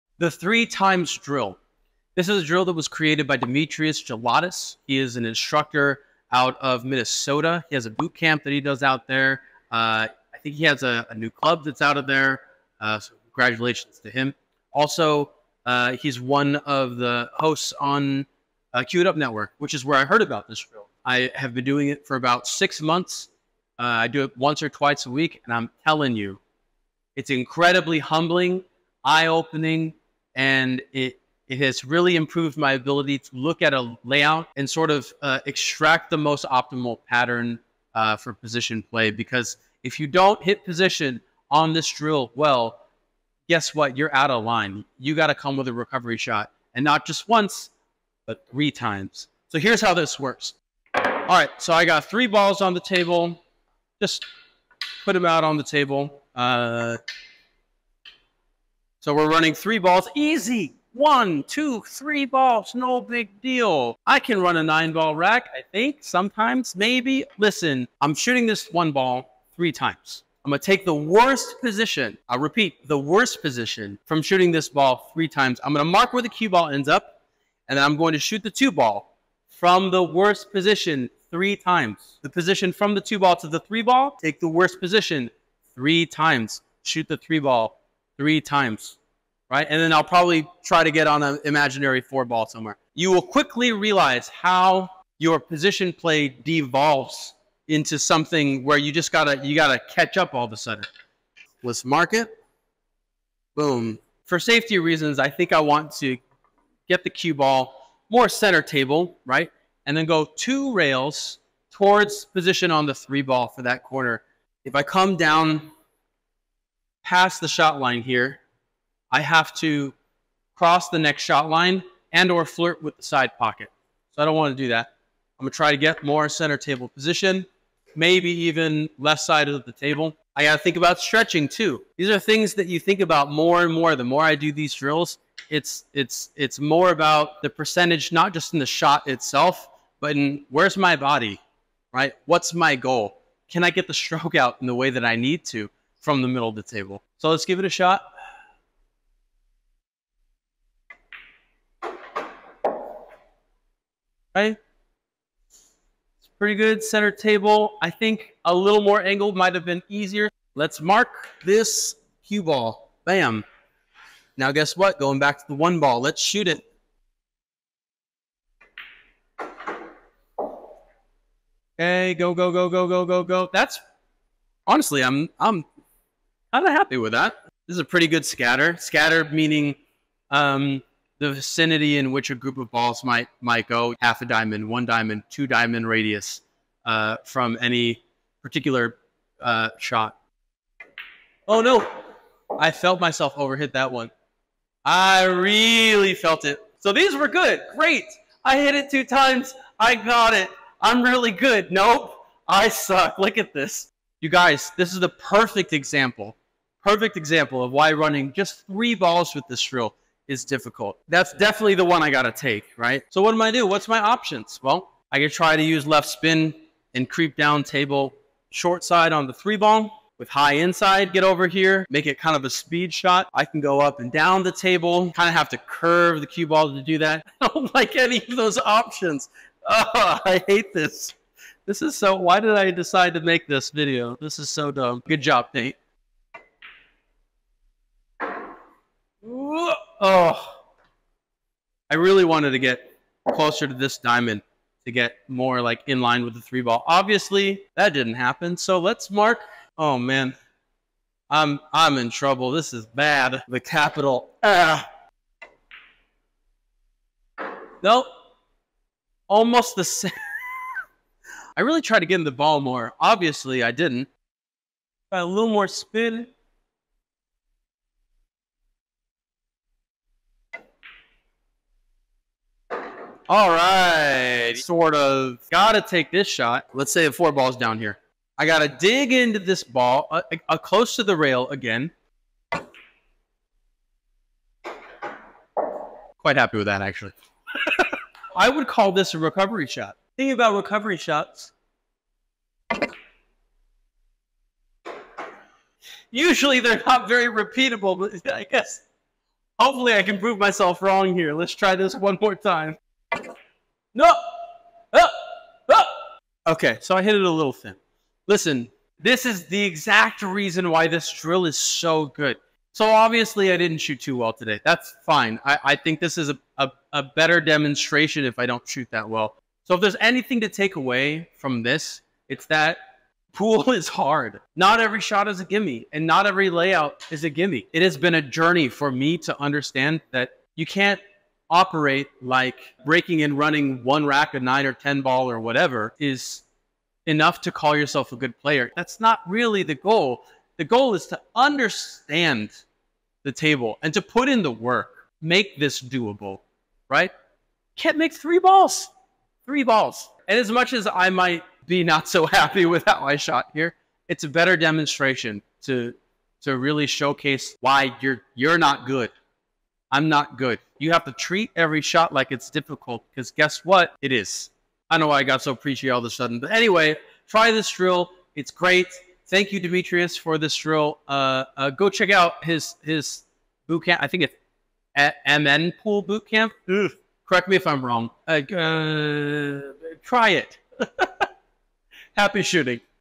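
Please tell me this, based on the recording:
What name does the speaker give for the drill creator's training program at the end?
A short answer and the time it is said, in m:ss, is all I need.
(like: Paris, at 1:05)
MN Pool Boot Camp, at 6:15.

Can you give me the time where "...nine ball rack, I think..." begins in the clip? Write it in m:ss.
1:04.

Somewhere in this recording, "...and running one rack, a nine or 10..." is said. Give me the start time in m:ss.
5:33.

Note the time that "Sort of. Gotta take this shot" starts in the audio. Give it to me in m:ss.
4:34.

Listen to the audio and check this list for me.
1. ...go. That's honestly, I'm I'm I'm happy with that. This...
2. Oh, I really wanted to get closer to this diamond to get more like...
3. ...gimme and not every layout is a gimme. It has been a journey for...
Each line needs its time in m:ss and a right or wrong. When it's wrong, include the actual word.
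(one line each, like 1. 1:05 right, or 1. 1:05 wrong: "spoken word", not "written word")
1. 2:53 right
2. 3:59 right
3. 5:25 right.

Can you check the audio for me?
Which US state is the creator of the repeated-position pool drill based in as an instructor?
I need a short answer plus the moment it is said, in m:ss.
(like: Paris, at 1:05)
Minnesota, at 0:06.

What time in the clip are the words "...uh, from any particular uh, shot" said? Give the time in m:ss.
3:06.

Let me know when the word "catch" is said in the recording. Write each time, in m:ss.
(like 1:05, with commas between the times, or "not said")
1:39.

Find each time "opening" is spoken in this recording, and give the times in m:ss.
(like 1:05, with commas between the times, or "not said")
0:29.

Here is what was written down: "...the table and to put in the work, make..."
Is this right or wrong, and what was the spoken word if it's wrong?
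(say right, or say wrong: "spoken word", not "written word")
right.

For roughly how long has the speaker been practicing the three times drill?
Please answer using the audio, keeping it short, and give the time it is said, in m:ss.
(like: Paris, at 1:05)
About six months, at 0:22.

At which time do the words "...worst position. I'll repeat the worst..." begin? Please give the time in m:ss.
1:10.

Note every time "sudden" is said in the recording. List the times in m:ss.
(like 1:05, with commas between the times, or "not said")
1:40, 6:06.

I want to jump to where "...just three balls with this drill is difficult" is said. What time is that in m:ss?
3:28.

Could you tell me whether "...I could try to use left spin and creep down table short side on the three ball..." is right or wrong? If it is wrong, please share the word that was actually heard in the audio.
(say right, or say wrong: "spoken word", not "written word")
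right.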